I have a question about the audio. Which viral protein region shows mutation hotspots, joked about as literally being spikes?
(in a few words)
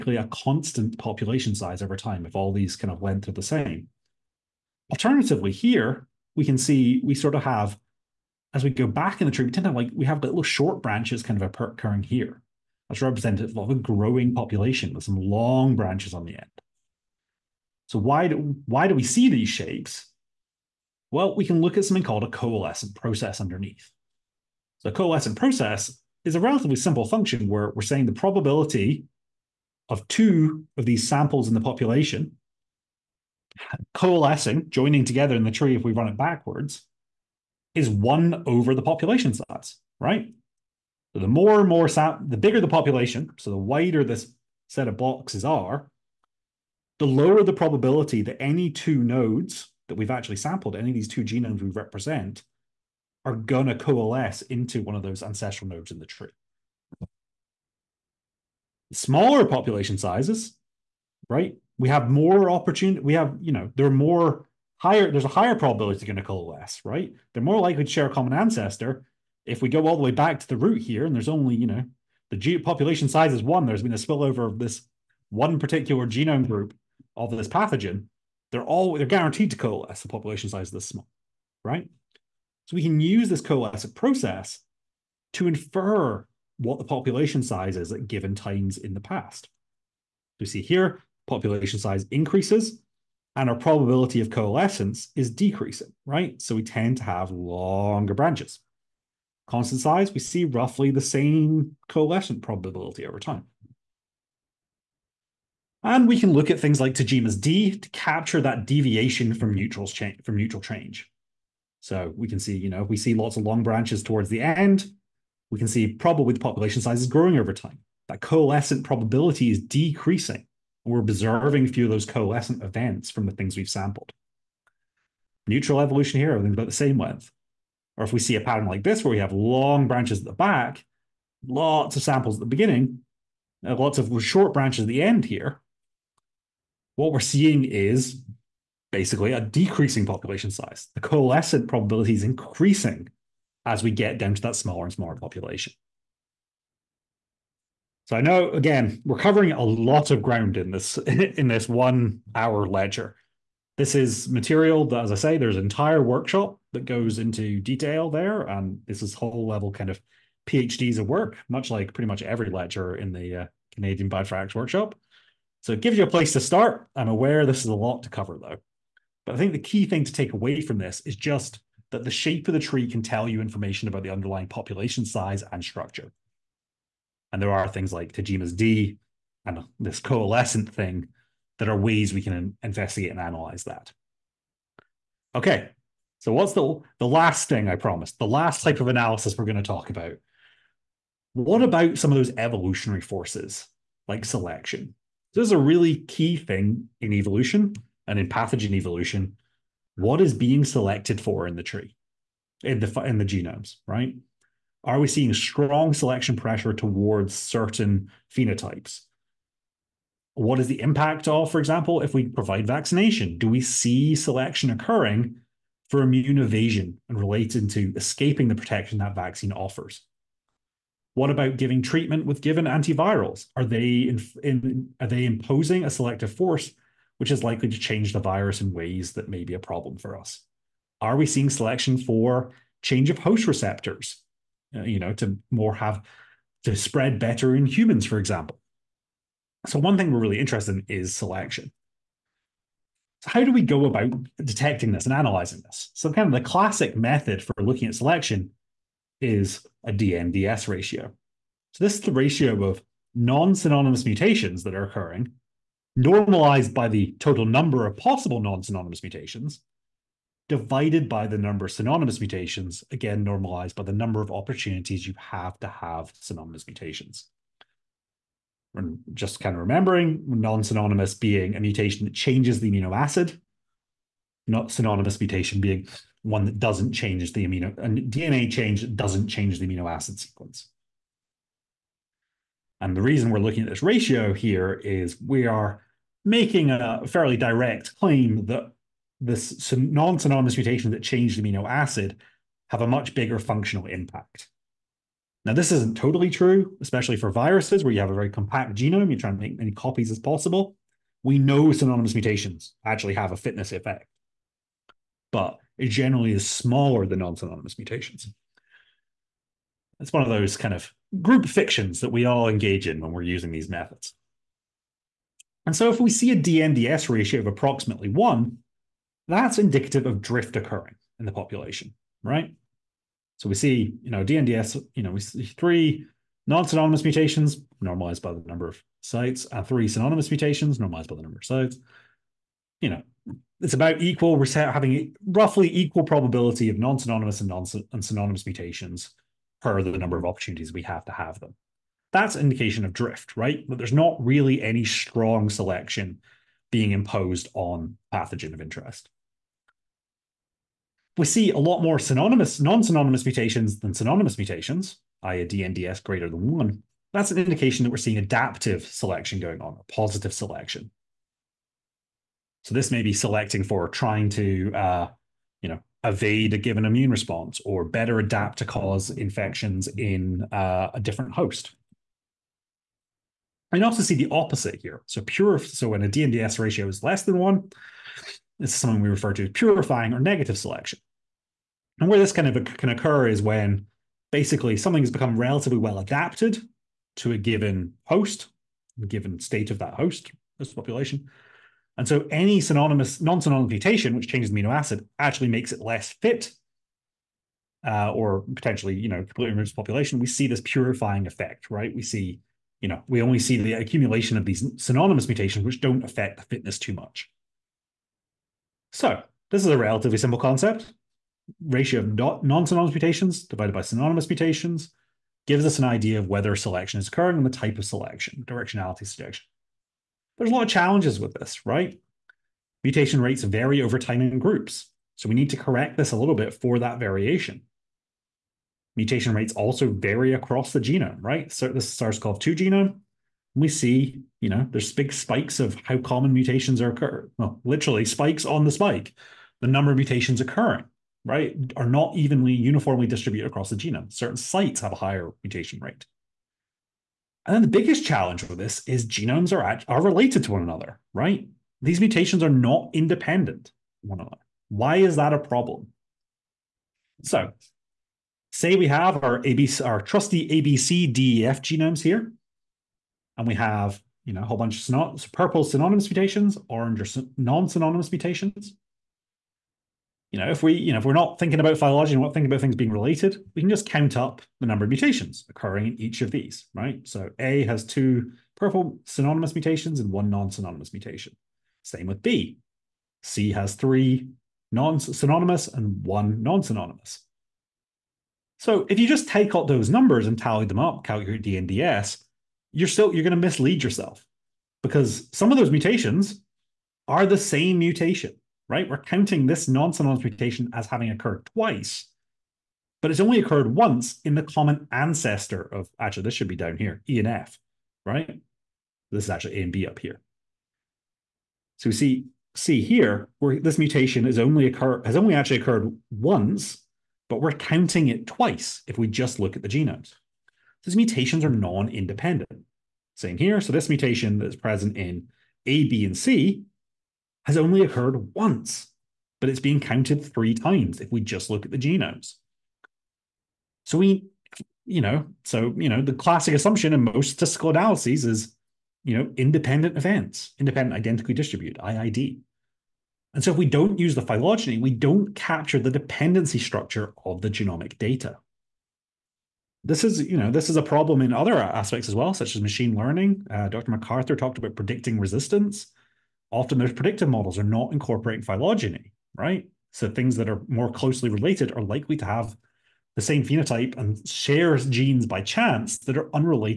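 The spike.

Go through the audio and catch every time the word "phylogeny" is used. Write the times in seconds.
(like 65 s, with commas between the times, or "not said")
471 s, 544 s, 558 s.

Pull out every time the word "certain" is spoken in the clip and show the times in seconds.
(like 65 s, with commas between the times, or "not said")
207 s, 444 s.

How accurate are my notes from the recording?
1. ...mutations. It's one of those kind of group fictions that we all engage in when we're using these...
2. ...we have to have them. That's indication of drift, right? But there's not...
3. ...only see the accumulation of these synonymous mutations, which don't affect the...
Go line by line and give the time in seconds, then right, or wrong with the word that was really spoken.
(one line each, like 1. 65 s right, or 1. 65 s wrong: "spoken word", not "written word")
1. 307 s right
2. 340 s right
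3. 403 s right.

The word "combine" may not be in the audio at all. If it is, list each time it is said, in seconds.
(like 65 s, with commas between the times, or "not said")
not said.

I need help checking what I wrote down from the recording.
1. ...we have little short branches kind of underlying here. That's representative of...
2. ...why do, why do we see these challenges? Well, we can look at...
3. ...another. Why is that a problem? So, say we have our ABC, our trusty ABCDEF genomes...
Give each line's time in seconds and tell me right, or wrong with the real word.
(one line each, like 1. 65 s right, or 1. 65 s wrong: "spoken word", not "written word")
1. 9 s wrong: "occurring", not "underlying"
2. 17 s wrong: "shapes", not "challenges"
3. 454 s right.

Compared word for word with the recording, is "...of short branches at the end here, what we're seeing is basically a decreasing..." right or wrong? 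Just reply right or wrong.
right.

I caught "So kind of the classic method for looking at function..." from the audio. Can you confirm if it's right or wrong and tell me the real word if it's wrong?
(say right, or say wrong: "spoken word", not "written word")
wrong: "selection", not "function".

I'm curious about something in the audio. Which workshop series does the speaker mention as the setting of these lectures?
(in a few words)
Canadian Bioinformatics Workshop.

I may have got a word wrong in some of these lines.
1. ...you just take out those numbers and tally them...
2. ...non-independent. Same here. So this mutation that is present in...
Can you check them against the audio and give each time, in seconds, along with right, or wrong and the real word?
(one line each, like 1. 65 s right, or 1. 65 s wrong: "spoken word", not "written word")
1. 488 s right
2. 521 s right.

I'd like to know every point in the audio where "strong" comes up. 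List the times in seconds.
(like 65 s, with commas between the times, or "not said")
205 s, 344 s.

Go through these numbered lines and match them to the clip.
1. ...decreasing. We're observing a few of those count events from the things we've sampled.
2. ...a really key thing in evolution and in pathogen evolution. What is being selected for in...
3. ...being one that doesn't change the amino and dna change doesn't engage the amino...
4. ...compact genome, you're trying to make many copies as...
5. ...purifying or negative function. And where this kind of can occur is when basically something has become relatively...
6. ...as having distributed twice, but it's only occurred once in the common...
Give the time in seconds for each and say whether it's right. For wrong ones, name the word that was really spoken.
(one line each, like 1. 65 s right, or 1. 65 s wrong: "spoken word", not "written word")
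1. 119 s wrong: "coalescent", not "count"
2. 195 s right
3. 275 s wrong: "change", not "engage"
4. 298 s right
5. 379 s wrong: "selection", not "function"
6. 500 s wrong: "occurred", not "distributed".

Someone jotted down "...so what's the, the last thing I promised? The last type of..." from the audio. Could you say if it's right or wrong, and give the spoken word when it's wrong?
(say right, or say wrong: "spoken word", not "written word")
right.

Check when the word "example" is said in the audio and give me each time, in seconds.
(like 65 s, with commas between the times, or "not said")
211 s, 238 s.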